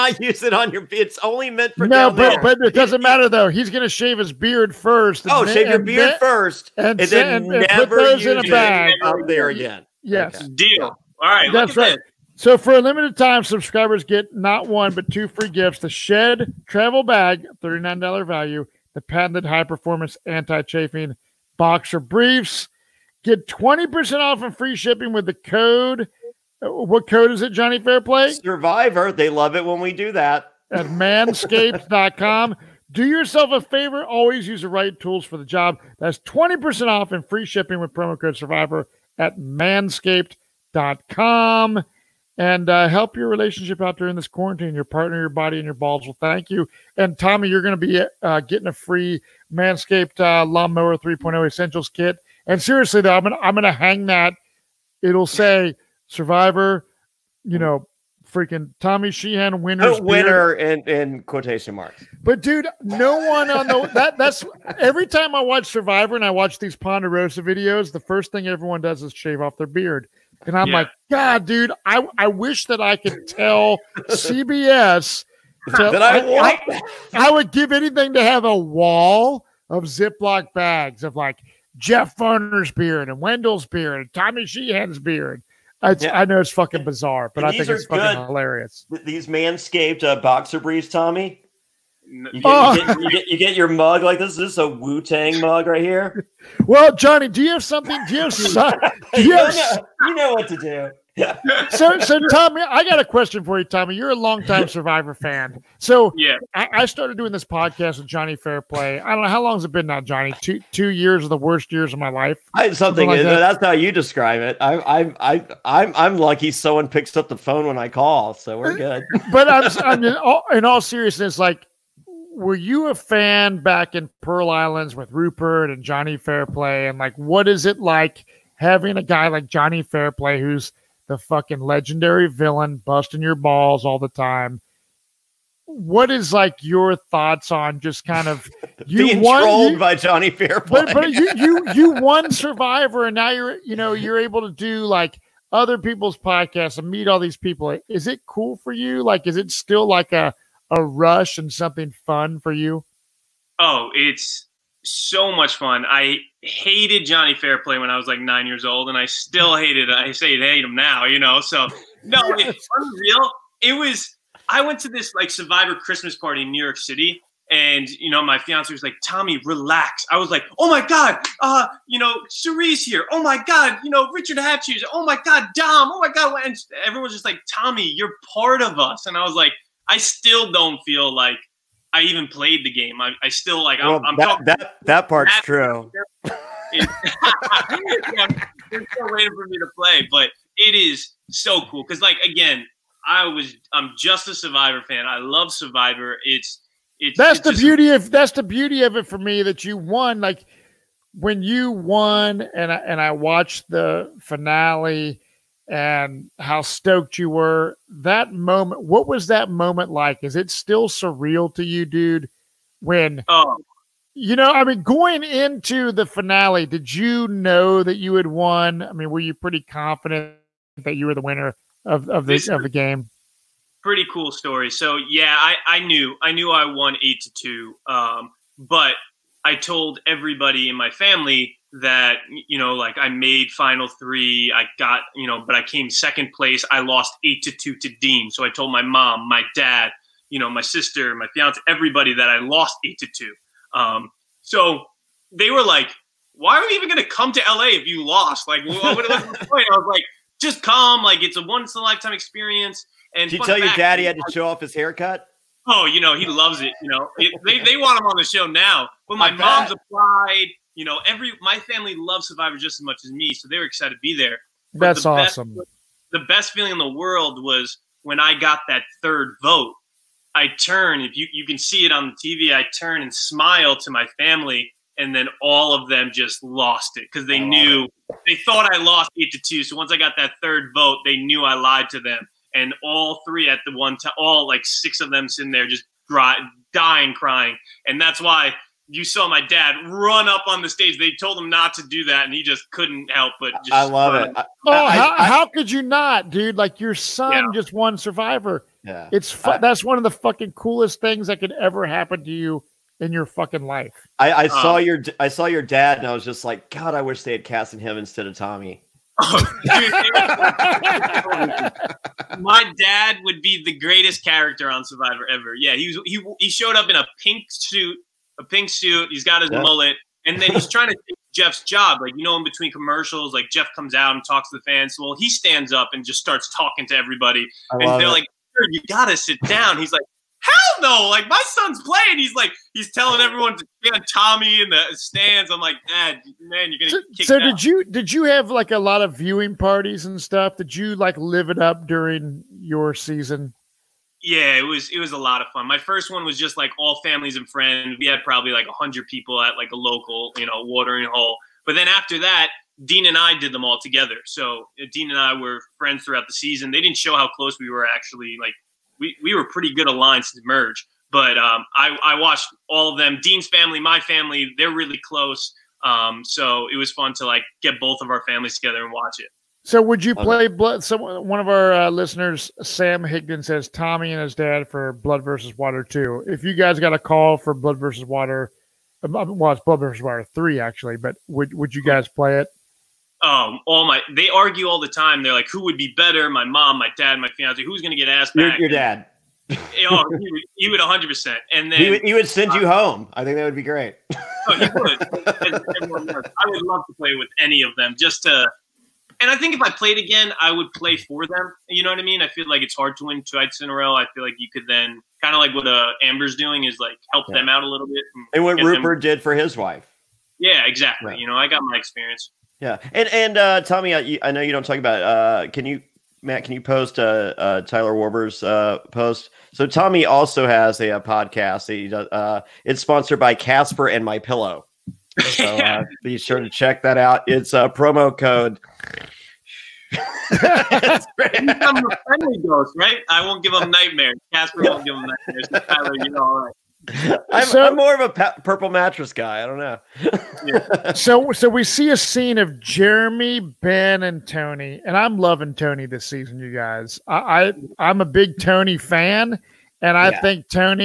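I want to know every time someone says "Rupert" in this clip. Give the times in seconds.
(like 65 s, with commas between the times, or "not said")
125 s, 408 s.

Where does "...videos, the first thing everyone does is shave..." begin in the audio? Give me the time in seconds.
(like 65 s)
67 s.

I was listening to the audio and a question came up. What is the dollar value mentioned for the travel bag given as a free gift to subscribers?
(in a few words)
$39.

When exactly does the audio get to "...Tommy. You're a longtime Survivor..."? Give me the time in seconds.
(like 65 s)
103 s.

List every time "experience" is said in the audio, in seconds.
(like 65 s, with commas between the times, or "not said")
252 s, 411 s.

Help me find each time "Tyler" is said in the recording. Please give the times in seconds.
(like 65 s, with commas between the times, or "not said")
417 s, 435 s.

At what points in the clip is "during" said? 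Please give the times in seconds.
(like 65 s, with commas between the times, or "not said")
43 s, 341 s.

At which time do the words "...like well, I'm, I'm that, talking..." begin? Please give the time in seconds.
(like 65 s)
183 s.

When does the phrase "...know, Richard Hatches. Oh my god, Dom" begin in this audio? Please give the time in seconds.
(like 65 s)
173 s.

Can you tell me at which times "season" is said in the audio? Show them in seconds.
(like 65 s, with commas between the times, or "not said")
342 s, 356 s, 446 s.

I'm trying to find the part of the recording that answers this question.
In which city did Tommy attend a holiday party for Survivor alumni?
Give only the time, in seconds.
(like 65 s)
166 s.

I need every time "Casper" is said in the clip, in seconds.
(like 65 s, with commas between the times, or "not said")
423 s, 434 s.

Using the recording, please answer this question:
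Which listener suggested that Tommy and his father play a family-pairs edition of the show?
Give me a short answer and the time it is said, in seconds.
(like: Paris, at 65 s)
Sam Higdon, at 372 s.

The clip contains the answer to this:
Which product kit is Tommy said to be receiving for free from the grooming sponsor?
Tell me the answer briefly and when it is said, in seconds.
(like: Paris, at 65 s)
Lawnmower 3.0 Essentials kit, at 50 s.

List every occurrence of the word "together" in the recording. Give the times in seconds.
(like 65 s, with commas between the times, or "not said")
353 s, 368 s.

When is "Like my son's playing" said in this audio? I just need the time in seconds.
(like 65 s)
331 s.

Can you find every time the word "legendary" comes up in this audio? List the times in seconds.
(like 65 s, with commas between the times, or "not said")
131 s.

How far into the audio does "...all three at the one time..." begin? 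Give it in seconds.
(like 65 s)
282 s.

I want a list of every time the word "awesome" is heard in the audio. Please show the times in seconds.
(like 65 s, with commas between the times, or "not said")
265 s.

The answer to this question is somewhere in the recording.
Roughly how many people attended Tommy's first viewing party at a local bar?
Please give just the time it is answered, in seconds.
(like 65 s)
348 s.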